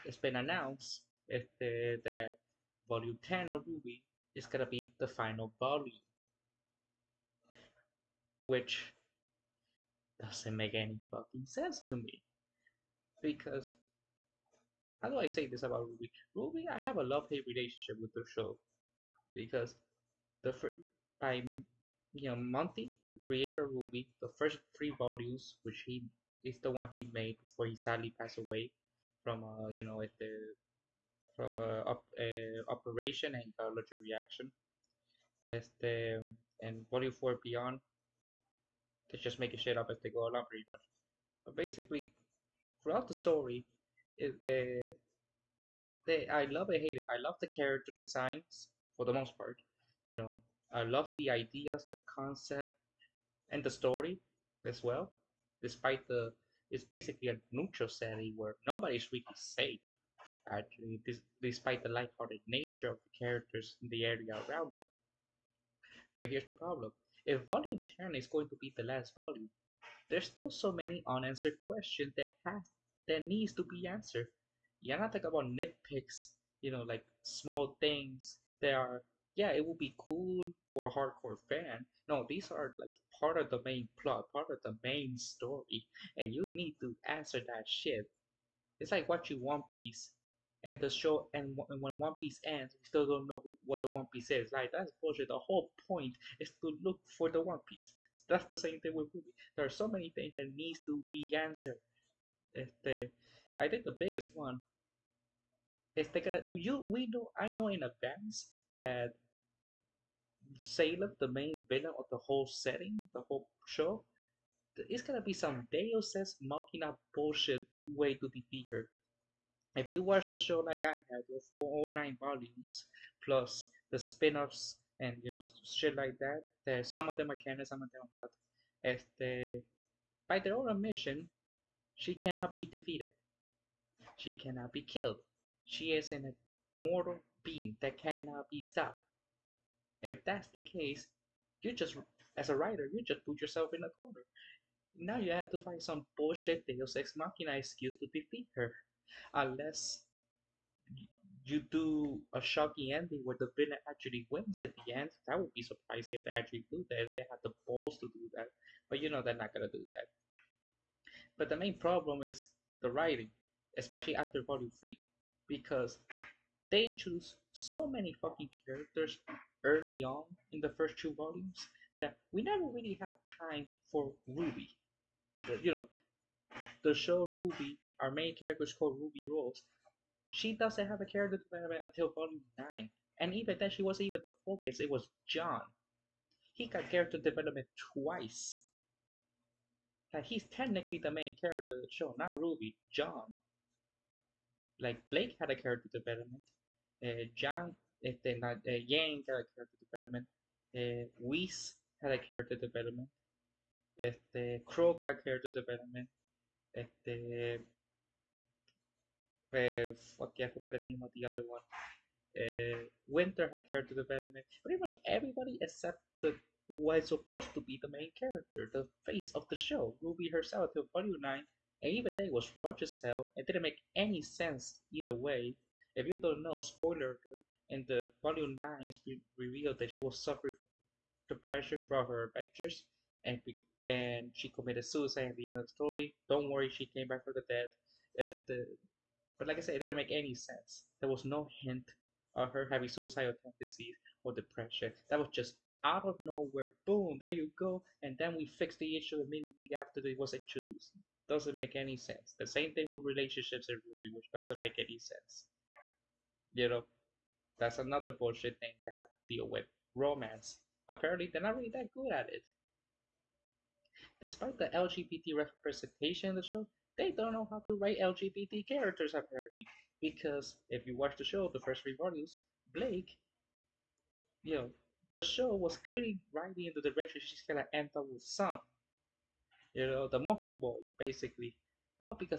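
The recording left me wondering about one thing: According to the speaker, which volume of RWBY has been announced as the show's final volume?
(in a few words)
10.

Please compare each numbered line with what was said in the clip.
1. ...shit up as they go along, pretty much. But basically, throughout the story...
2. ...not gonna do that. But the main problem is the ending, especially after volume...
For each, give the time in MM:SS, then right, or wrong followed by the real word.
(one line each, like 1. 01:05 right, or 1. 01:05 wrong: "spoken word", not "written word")
1. 00:39 right
2. 02:39 wrong: "writing", not "ending".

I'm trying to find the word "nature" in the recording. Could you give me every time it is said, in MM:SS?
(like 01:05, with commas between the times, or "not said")
01:02.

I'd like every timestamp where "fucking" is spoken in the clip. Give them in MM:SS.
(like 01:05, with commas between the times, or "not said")
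00:11, 02:48.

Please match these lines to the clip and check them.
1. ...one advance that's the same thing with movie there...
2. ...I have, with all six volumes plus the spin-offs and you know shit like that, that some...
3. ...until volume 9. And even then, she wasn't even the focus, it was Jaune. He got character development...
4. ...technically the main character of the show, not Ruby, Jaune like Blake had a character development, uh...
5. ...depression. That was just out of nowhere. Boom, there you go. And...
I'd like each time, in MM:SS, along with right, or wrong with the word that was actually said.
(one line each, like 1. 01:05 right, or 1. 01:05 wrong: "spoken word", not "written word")
1. 01:37 wrong: "piece", not "advance"
2. 02:00 wrong: "nine", not "six"
3. 03:01 right
4. 03:10 right
5. 04:04 right.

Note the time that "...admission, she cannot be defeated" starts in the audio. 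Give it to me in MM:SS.
02:10.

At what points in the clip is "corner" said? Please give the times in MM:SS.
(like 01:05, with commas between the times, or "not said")
02:23.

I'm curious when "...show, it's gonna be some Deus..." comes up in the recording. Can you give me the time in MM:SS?
01:53.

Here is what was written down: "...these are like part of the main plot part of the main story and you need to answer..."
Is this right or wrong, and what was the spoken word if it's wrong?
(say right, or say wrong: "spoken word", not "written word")
right.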